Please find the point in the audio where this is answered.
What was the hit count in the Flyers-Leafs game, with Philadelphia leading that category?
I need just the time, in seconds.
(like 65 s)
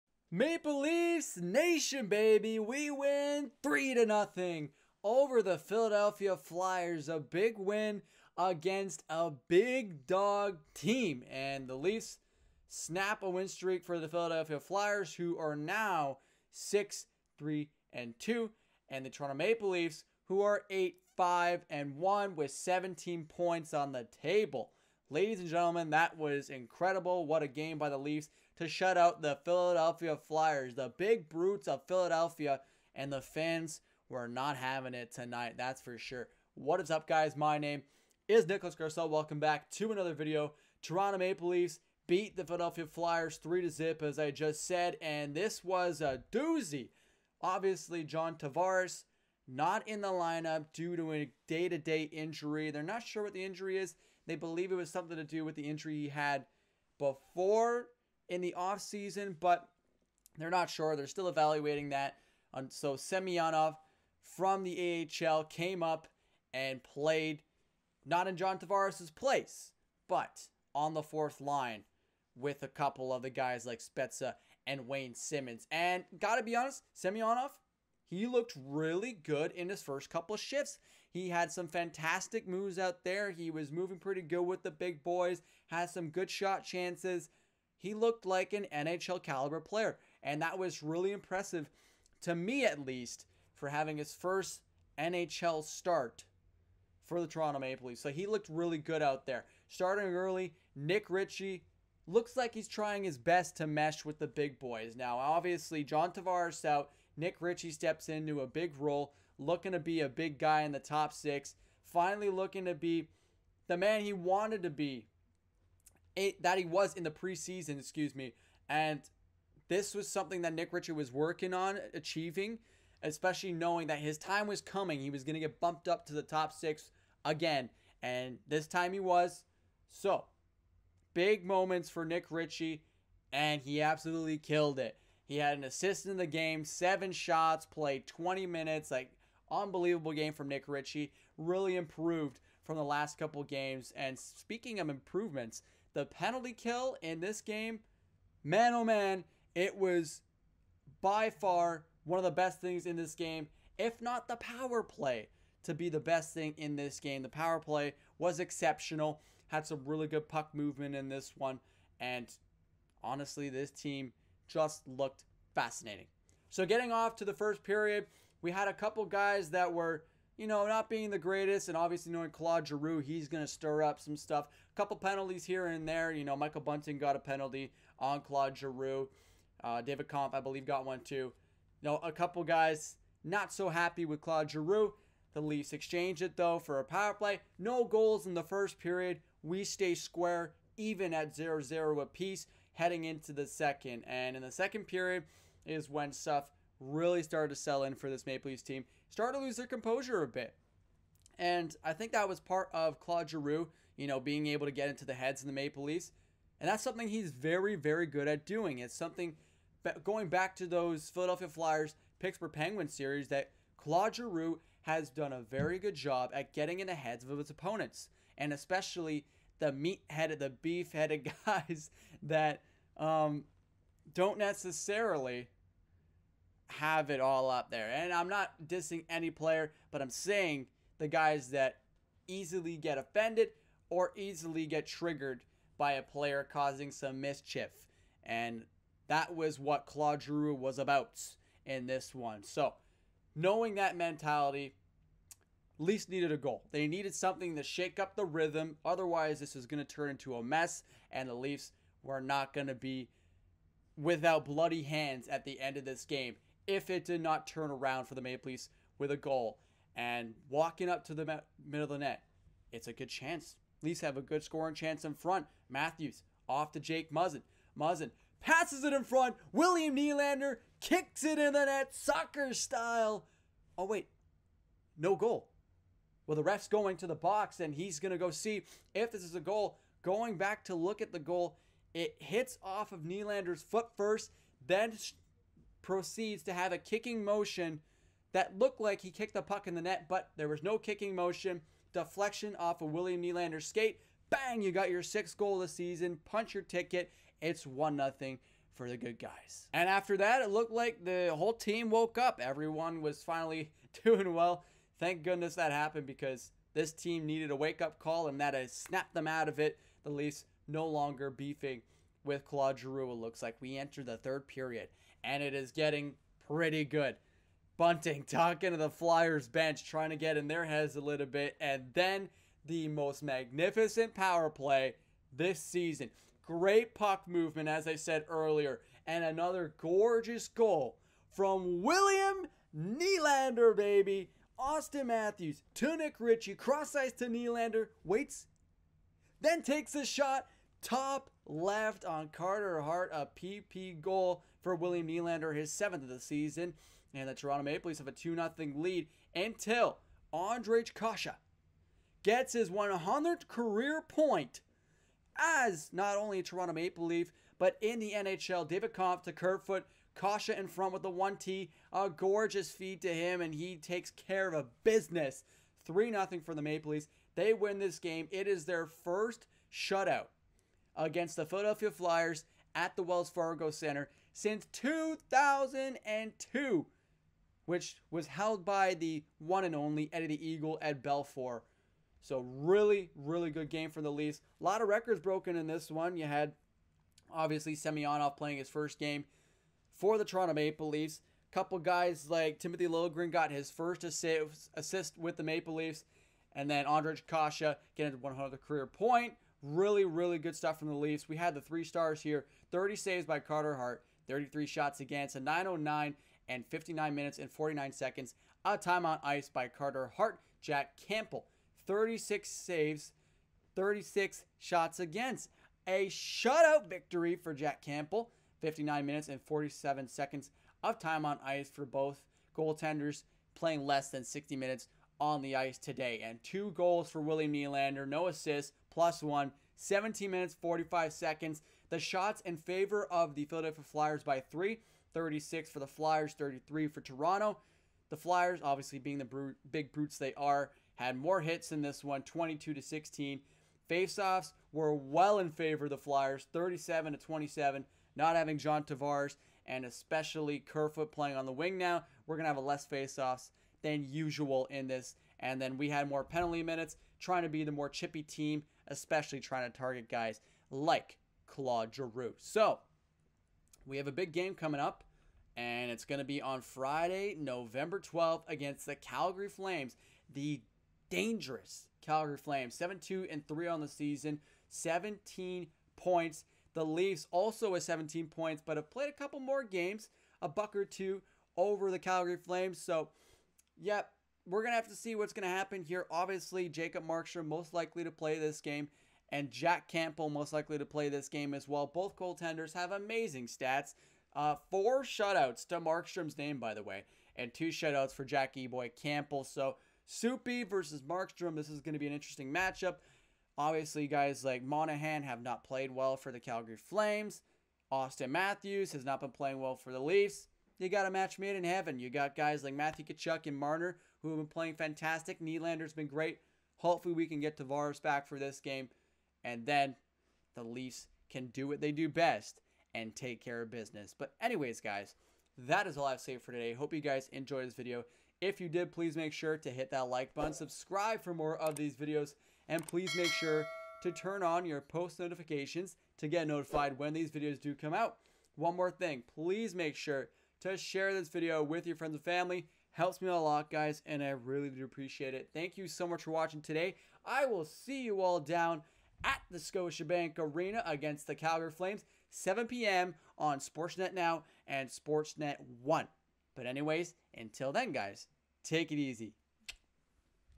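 442 s.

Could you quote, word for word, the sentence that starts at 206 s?
And that's something he's very, very good at doing.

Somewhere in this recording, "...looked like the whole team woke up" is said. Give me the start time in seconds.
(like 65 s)
300 s.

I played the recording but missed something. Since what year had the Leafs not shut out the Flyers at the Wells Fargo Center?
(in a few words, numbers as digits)
2002.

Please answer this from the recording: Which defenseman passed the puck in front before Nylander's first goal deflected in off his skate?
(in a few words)
Jake Muzzin.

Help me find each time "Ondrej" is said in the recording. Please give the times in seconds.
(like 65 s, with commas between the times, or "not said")
350 s, 396 s.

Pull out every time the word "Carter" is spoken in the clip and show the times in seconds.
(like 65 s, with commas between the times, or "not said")
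342 s, 403 s, 409 s.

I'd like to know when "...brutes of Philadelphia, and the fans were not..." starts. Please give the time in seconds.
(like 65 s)
31 s.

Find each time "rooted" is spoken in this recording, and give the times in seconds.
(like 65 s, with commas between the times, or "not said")
not said.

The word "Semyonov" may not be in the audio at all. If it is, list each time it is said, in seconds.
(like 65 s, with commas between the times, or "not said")
62 s, 76 s, 387 s.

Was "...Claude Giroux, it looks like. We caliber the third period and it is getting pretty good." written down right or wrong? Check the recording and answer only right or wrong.
wrong.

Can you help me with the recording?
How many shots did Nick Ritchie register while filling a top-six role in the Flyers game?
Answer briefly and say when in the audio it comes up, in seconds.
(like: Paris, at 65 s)
7, at 136 s.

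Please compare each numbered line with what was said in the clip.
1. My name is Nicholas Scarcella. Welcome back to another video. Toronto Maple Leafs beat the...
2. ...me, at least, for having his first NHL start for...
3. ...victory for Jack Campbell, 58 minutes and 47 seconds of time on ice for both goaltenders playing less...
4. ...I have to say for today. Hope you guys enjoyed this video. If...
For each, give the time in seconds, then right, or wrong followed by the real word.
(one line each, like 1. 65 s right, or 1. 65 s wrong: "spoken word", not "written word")
1. 37 s right
2. 92 s right
3. 416 s wrong: "59", not "58"
4. 526 s right.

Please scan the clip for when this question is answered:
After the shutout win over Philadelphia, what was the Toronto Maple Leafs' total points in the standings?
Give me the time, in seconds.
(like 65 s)
22 s.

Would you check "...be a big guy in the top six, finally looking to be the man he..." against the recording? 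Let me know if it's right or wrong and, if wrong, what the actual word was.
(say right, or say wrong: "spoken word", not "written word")
right.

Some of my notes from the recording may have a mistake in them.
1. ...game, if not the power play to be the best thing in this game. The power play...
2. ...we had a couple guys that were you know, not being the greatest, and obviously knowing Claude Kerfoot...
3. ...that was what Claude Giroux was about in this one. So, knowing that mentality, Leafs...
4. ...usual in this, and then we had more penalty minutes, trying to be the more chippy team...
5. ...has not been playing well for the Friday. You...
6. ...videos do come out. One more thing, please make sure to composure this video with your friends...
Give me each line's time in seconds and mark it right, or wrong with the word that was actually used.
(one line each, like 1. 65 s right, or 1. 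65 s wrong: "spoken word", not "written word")
1. 153 s right
2. 168 s wrong: "Giroux", not "Kerfoot"
3. 239 s right
4. 454 s right
5. 508 s wrong: "Leafs", not "Friday"
6. 537 s wrong: "share", not "composure".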